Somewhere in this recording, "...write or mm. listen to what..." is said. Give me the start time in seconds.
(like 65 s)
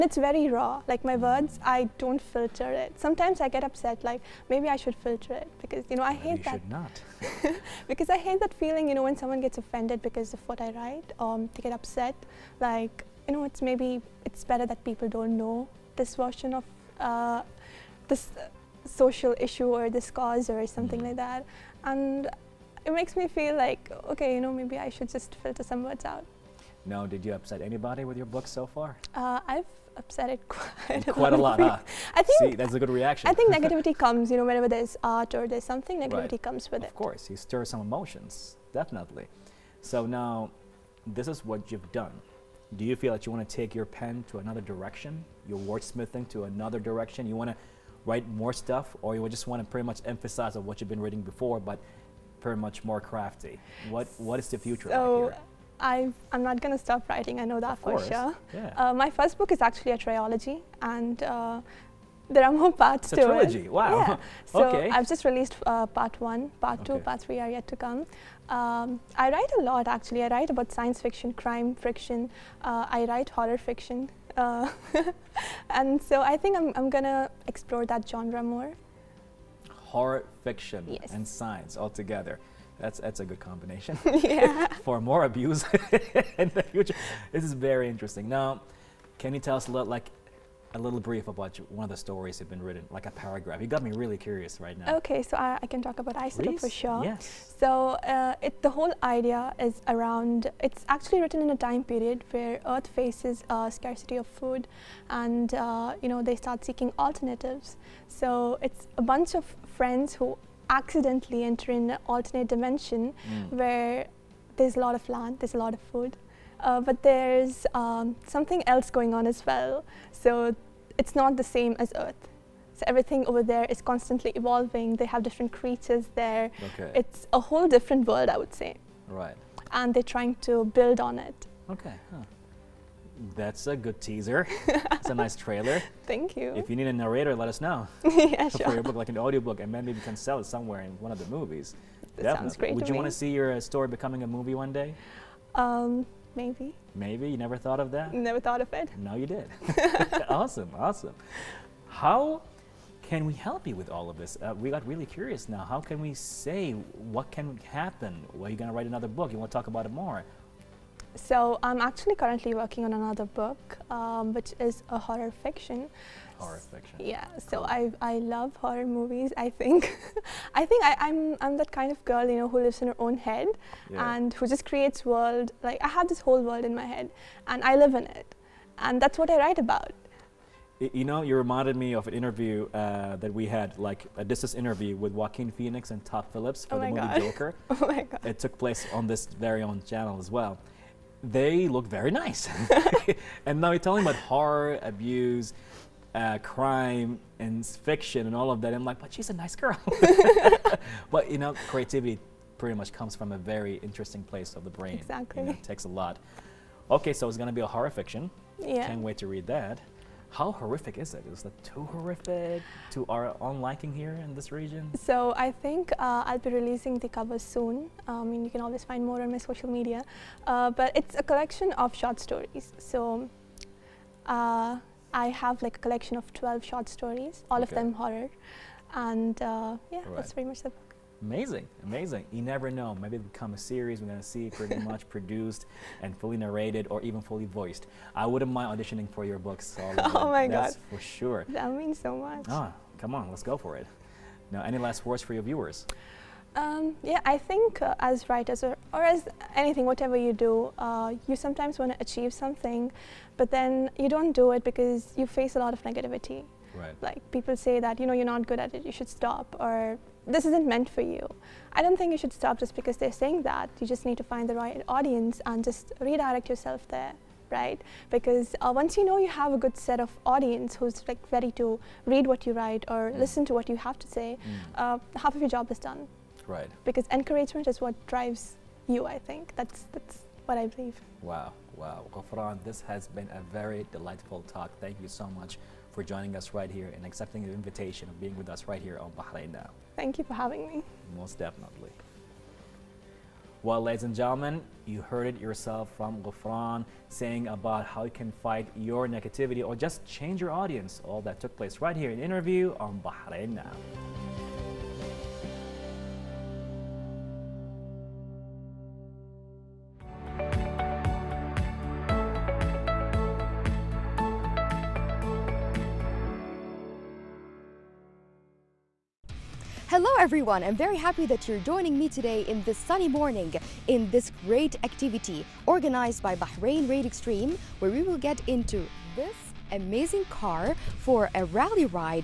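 272 s.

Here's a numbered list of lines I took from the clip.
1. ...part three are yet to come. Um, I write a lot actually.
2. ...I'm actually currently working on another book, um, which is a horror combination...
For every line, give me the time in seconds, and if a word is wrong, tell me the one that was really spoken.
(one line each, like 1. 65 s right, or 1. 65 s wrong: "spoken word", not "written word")
1. 66 s right
2. 161 s wrong: "fiction", not "combination".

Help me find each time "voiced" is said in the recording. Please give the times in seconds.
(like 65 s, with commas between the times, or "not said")
237 s.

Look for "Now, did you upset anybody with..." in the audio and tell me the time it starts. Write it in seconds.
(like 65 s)
26 s.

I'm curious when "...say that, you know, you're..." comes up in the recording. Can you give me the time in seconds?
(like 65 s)
257 s.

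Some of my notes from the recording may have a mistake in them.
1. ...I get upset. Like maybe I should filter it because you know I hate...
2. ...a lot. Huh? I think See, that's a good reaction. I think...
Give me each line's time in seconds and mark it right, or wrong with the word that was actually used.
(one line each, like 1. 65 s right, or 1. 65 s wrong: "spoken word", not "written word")
1. 3 s right
2. 31 s right.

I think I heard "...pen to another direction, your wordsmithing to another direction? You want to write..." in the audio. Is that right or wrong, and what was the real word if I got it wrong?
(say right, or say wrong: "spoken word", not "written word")
right.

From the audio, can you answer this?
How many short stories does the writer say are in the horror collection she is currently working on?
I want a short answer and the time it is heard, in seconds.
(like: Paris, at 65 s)
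12, at 226 s.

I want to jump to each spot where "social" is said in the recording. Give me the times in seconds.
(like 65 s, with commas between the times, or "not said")
18 s, 219 s.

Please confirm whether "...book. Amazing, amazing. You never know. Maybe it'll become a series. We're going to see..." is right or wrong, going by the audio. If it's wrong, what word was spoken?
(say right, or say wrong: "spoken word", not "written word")
right.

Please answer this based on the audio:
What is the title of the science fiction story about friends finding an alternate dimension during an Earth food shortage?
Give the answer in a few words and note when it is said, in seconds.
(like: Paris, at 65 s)
Isotope, at 96 s.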